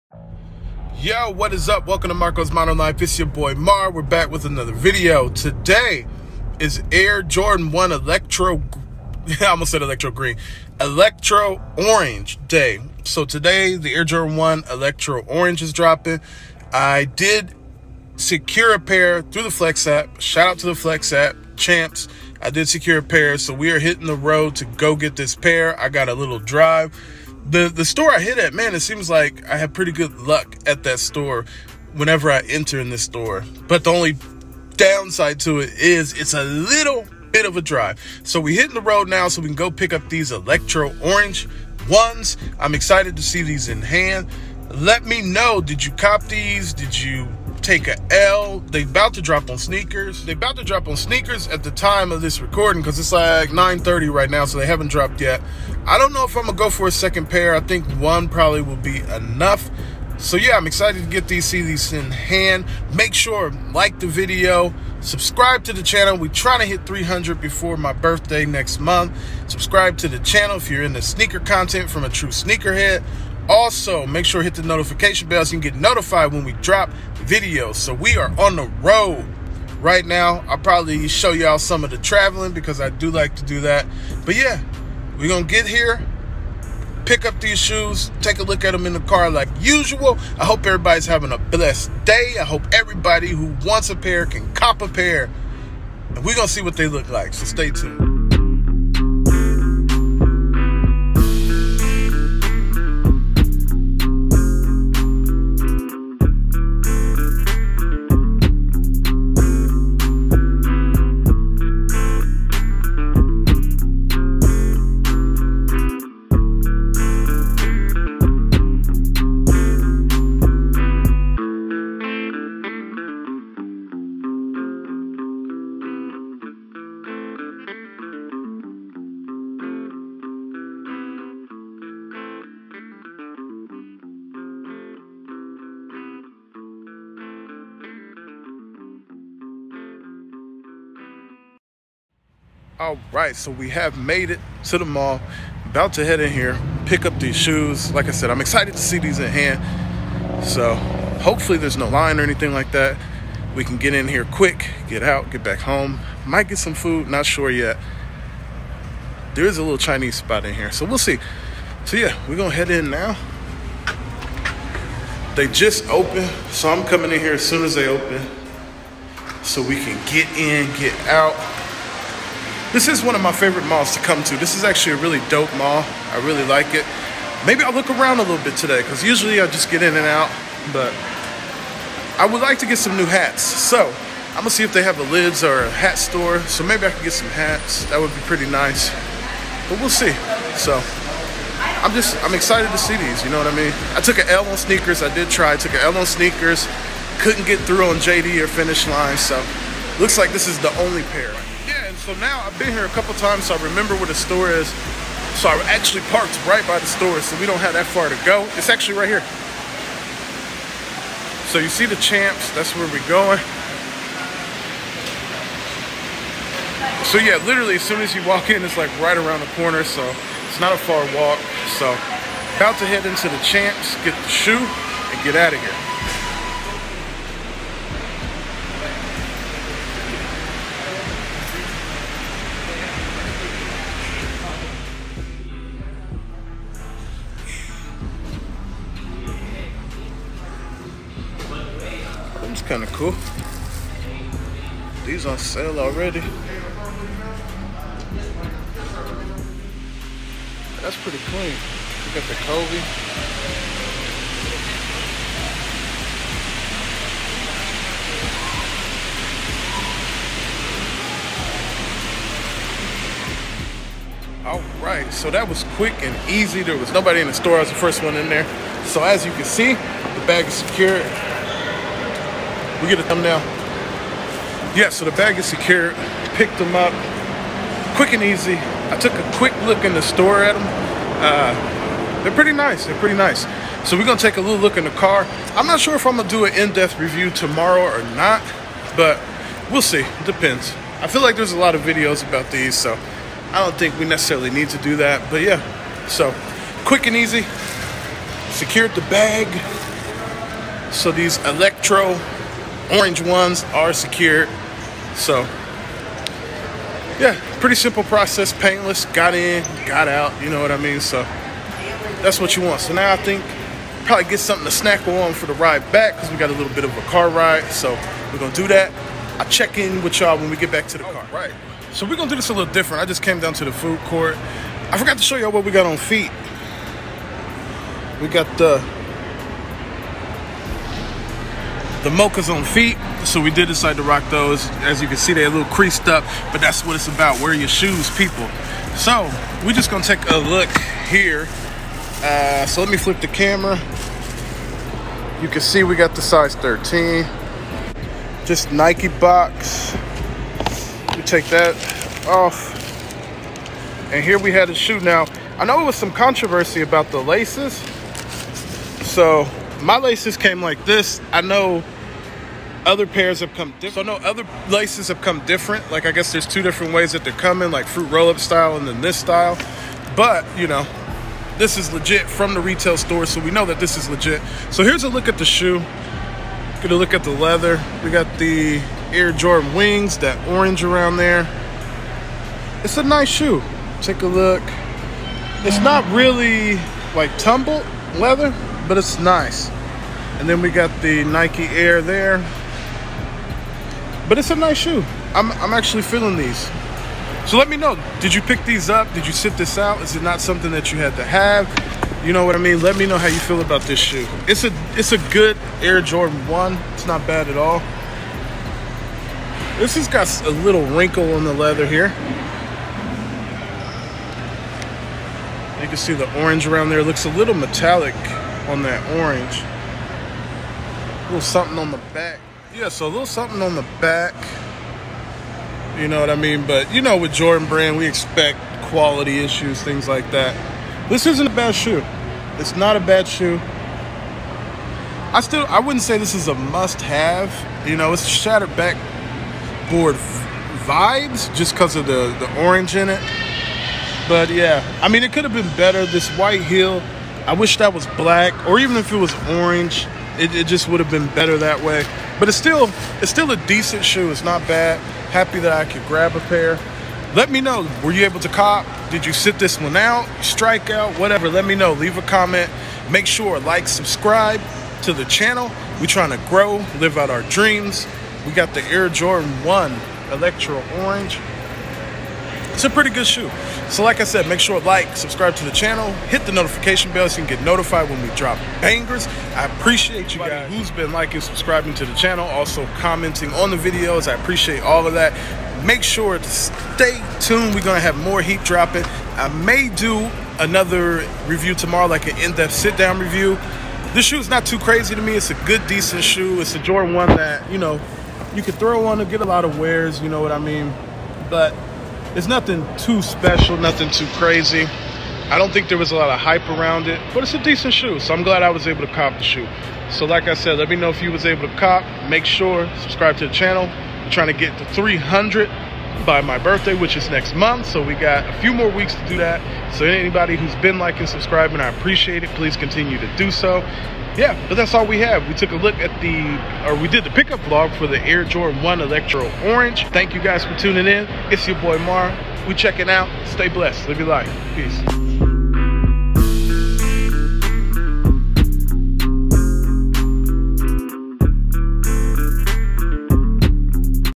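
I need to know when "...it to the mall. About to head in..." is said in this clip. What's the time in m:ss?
2:24.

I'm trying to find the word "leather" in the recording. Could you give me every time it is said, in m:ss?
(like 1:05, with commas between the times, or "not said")
6:17, 6:28, 6:51.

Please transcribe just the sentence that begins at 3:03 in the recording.
So I'm gonna see if they have a lids or a hat store.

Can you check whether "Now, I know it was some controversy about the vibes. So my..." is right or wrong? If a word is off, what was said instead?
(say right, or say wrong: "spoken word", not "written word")
wrong: "laces", not "vibes".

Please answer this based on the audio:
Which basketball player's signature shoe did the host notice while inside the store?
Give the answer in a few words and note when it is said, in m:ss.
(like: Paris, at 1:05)
Kobe, at 4:12.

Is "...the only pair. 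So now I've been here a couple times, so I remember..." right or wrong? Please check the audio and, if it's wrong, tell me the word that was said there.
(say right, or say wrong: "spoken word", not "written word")
right.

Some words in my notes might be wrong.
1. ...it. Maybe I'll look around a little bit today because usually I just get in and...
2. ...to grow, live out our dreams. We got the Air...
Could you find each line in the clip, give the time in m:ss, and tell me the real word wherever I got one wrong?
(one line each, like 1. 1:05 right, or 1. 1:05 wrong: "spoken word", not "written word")
1. 2:56 right
2. 7:46 right.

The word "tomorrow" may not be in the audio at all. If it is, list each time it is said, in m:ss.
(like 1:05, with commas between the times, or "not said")
4:47, 8:11.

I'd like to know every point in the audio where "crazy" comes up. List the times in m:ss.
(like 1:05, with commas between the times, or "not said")
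8:14, 8:24.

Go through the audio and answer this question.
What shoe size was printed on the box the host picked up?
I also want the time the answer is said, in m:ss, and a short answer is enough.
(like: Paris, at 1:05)
13, at 5:46.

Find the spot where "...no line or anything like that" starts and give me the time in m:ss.
2:31.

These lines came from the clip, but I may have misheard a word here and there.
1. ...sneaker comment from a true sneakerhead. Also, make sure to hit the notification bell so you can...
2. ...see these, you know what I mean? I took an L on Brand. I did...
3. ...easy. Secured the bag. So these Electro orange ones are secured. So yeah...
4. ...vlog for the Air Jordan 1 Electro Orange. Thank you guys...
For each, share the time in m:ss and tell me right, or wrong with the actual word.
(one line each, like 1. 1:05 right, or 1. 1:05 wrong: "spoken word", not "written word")
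1. 1:11 wrong: "content", not "comment"
2. 3:12 wrong: "SNKRS", not "Brand"
3. 4:57 right
4. 8:47 right.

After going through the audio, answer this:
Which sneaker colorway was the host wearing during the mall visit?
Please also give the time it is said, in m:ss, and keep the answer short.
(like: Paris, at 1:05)
Mochas, at 5:32.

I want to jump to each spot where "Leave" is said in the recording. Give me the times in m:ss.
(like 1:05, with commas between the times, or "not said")
7:41.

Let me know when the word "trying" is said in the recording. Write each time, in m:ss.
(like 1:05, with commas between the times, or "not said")
1:06, 7:46, 8:34.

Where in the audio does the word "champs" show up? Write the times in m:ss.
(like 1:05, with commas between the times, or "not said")
0:21, 3:32, 3:43.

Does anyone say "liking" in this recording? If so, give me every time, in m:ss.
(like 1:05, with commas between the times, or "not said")
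8:01, 8:40.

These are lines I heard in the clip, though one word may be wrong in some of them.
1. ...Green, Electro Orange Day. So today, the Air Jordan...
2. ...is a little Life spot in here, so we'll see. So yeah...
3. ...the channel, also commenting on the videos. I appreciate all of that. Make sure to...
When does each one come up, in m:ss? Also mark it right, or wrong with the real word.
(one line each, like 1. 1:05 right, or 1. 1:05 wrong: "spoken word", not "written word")
1. 0:10 right
2. 2:39 wrong: "Chinese", not "Life"
3. 8:02 right.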